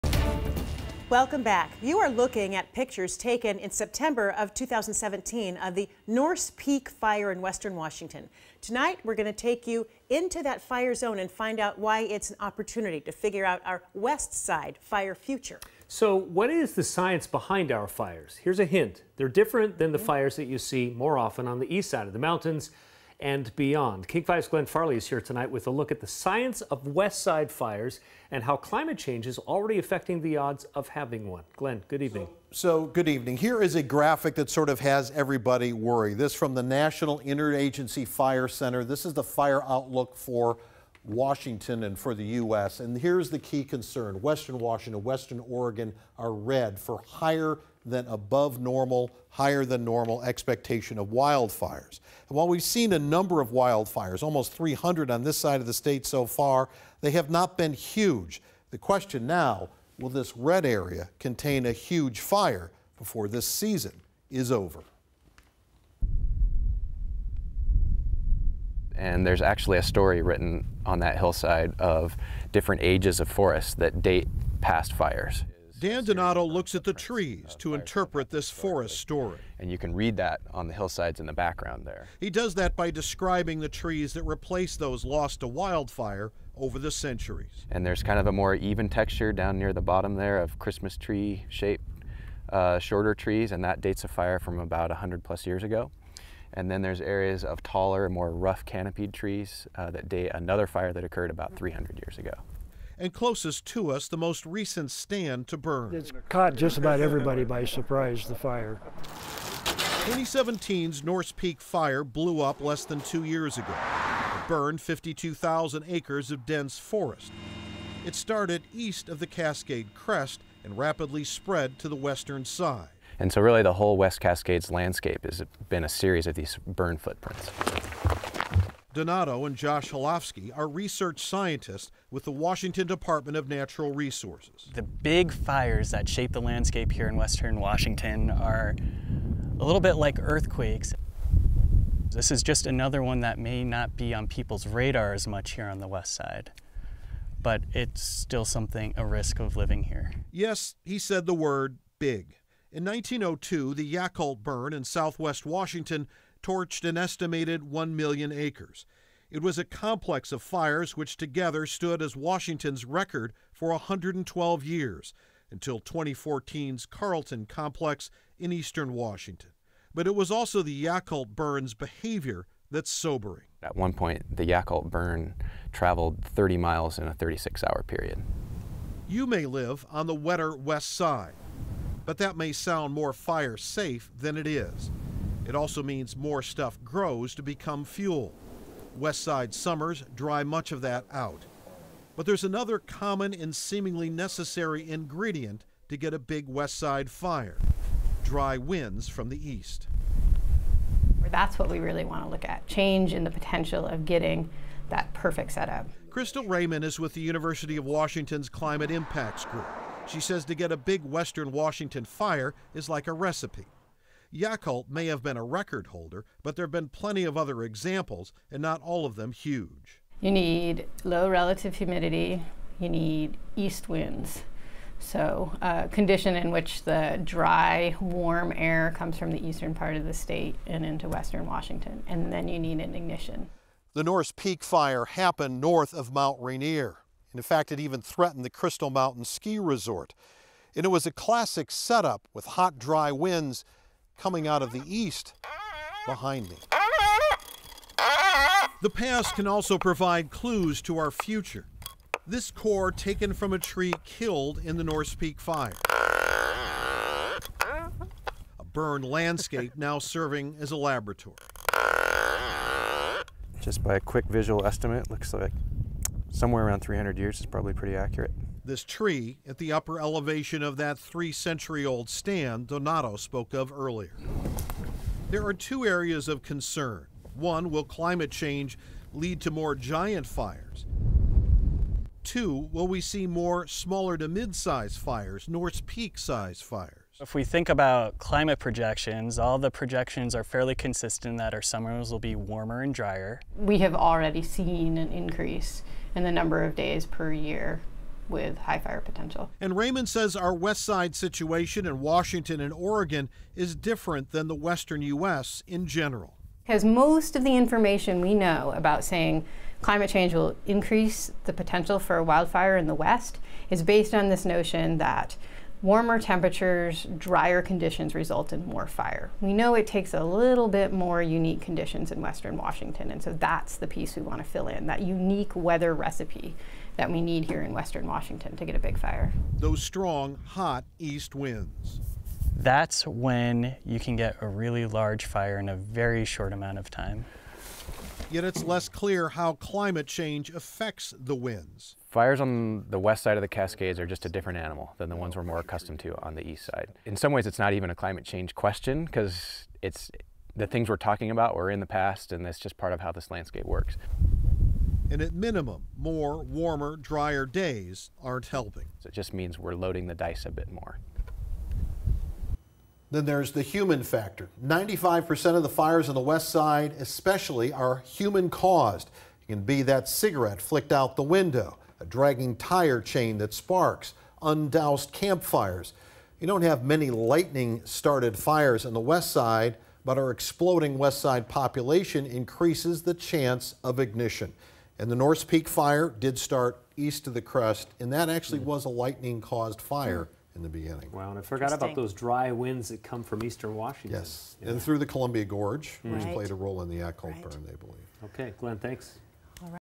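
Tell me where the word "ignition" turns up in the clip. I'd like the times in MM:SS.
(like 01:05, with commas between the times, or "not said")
03:52, 06:23.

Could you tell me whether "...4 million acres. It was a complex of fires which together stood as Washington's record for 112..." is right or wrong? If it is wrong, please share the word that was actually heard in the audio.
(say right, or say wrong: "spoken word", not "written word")
wrong: "1", not "4".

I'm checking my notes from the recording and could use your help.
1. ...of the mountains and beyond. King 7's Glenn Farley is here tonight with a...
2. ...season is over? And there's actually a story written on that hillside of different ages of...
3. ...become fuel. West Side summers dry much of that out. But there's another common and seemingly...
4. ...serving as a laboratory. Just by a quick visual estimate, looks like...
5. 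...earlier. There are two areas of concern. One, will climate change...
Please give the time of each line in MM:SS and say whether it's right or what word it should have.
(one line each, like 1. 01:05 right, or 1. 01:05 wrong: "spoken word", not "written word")
1. 00:22 wrong: "5", not "7"
2. 01:03 right
3. 03:07 right
4. 04:19 right
5. 04:33 right.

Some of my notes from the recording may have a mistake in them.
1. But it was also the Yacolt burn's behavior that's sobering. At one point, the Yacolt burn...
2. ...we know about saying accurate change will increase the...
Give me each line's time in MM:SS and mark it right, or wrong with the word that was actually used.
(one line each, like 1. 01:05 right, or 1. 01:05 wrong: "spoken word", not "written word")
1. 02:49 right
2. 05:08 wrong: "climate", not "accurate".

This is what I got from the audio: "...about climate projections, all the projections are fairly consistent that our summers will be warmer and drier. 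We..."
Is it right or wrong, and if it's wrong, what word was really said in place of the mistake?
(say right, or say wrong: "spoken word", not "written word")
right.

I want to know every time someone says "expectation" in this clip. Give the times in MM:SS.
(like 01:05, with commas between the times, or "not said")
00:50.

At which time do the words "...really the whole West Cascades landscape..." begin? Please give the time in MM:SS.
02:03.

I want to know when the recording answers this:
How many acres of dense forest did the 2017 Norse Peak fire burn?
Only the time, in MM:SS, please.
01:54.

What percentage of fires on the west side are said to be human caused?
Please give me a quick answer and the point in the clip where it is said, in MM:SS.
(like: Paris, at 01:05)
95%, at 06:04.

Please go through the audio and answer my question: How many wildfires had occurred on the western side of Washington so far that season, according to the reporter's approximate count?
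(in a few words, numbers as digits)
300.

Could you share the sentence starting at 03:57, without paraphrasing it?
And in fact, it even threatened the Crystal Mountain Ski Resort.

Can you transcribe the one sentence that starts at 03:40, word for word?
You need low relative humidity, you need east winds.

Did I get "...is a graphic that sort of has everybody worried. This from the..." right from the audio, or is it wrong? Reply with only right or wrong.
right.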